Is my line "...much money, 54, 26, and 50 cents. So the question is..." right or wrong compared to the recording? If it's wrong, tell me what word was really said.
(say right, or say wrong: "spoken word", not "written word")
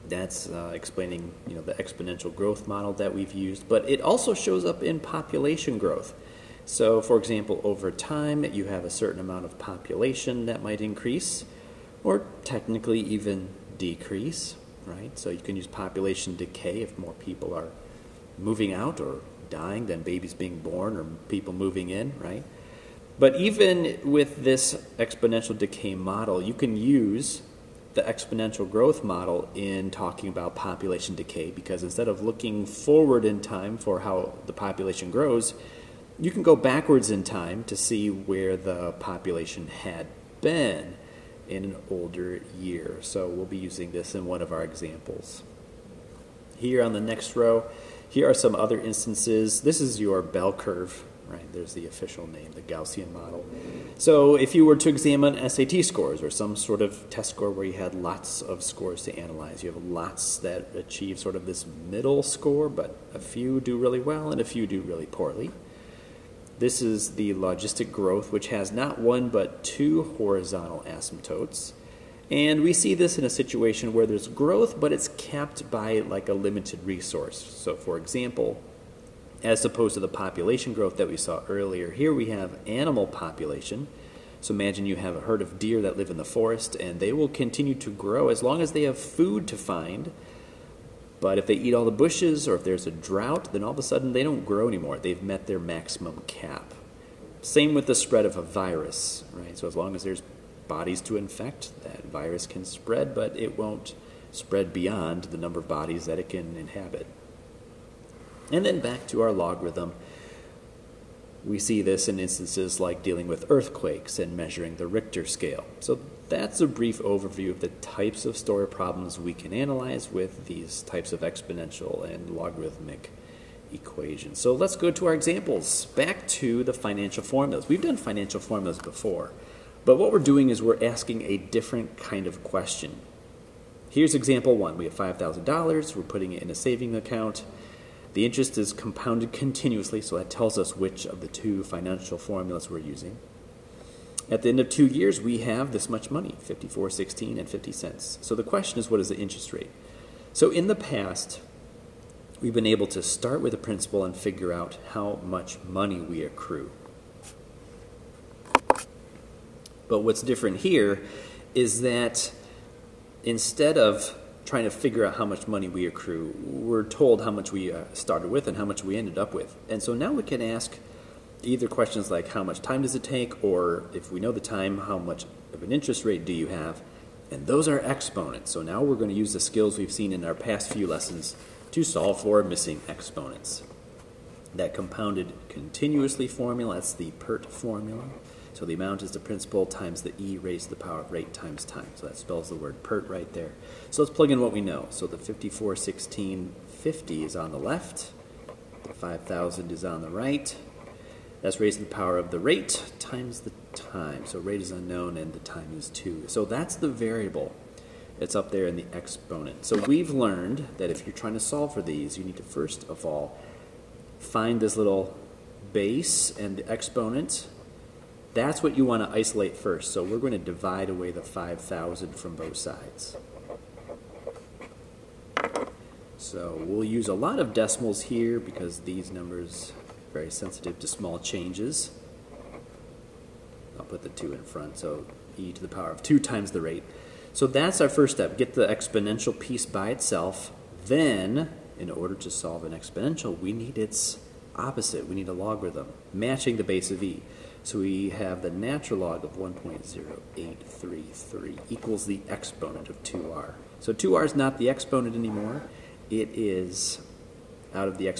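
wrong: "16", not "26".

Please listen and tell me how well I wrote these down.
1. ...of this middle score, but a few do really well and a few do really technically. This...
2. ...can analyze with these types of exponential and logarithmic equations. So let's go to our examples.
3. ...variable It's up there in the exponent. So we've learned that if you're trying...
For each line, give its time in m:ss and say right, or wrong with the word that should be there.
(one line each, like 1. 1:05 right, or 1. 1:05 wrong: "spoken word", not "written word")
1. 1:01 wrong: "poorly", not "technically"
2. 1:59 right
3. 3:26 right.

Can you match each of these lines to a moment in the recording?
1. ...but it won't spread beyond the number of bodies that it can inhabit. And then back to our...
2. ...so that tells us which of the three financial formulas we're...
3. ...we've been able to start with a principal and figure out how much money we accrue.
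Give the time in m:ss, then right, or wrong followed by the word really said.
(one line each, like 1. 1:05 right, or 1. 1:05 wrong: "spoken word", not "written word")
1. 1:43 right
2. 2:20 wrong: "two", not "three"
3. 2:32 right.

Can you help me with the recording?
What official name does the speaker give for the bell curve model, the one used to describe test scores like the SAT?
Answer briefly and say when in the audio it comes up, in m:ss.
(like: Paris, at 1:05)
Gaussian model, at 0:52.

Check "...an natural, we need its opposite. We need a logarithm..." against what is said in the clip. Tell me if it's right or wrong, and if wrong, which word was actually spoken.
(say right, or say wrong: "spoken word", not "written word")
wrong: "exponential", not "natural".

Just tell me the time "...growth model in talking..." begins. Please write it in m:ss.
0:28.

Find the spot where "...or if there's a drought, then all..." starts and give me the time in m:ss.
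1:32.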